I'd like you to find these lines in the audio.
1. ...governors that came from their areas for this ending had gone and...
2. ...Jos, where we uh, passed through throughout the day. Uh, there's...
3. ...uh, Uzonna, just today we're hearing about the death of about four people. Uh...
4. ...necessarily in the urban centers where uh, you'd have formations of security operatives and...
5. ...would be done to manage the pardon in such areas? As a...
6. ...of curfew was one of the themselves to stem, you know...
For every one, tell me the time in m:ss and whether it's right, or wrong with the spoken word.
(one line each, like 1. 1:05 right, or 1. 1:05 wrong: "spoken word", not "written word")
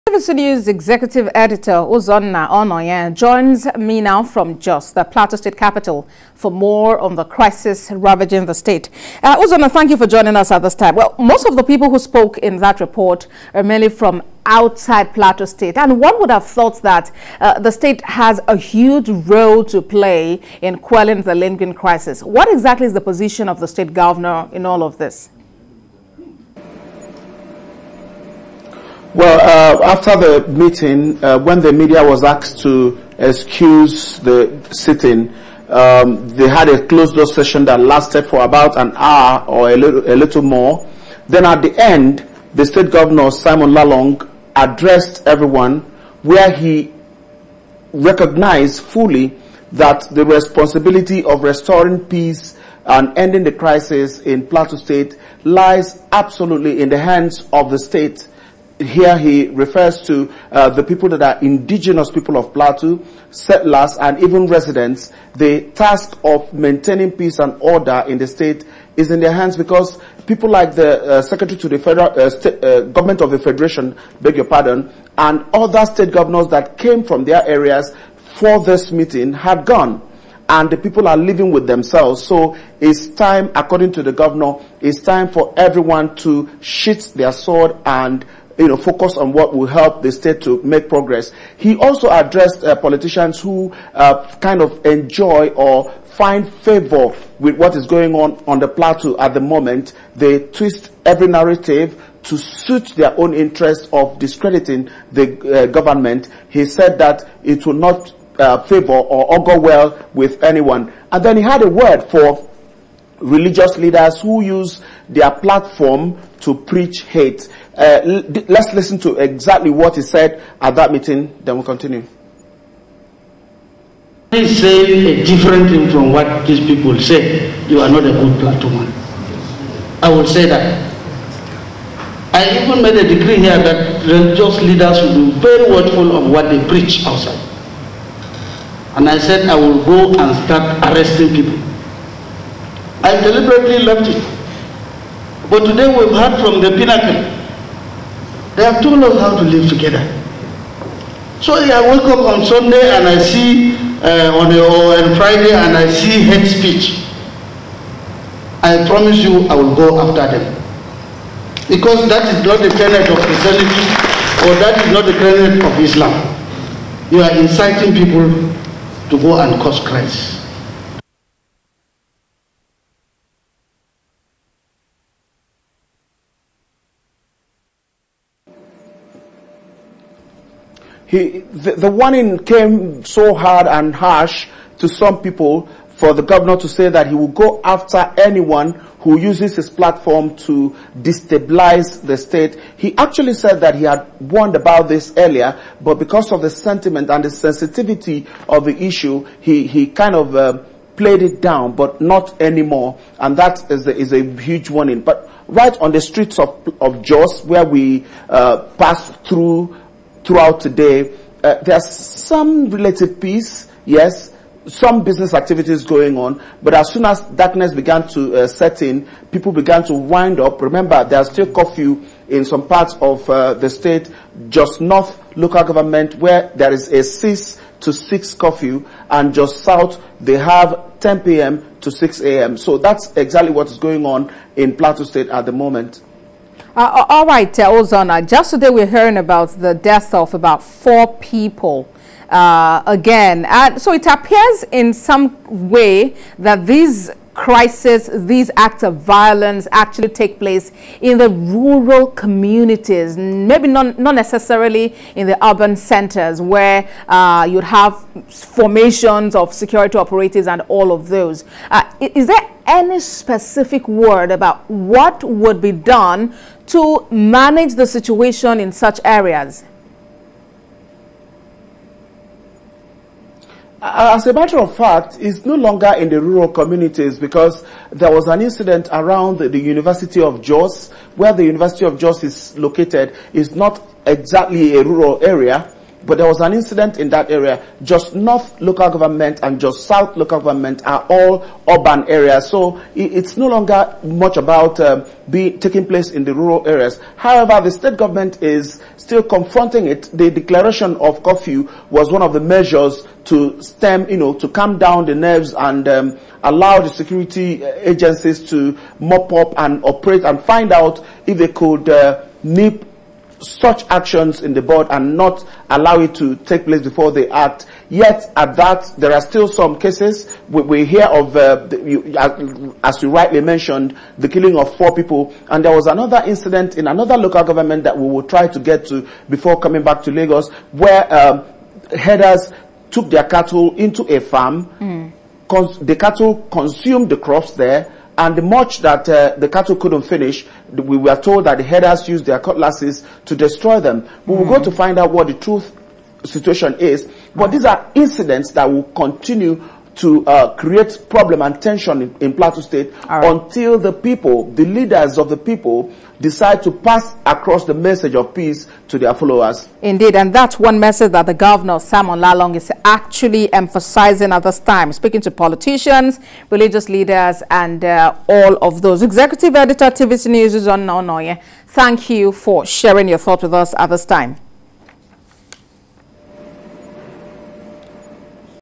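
1. 1:16 wrong: "meeting", not "ending"
2. 3:27 right
3. 3:57 right
4. 4:14 right
5. 4:25 wrong: "situation", not "pardon"
6. 5:00 wrong: "measures", not "themselves".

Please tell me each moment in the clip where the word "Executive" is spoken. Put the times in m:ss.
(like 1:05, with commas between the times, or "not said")
0:00, 6:09.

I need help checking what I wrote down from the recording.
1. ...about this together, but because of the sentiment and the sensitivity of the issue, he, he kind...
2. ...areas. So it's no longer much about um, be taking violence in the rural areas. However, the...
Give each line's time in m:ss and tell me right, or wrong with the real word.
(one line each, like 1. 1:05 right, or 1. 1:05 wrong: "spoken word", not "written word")
1. 3:14 wrong: "earlier", not "together"
2. 4:52 wrong: "place", not "violence".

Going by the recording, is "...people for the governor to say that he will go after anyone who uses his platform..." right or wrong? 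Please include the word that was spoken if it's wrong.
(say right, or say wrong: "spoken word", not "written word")
right.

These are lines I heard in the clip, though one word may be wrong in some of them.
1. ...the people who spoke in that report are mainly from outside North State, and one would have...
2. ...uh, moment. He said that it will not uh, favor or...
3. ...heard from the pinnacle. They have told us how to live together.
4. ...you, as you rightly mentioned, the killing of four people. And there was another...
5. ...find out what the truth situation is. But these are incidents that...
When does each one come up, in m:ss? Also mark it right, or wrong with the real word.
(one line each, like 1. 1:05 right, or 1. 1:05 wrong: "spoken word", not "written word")
1. 0:11 wrong: "Plateau", not "North"
2. 1:45 wrong: "government", not "moment"
3. 2:26 right
4. 5:21 right
5. 5:44 right.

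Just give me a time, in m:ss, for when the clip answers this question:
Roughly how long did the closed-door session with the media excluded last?
0:38.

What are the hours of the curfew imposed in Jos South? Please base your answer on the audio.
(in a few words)
10 p.m. to 6 a.m.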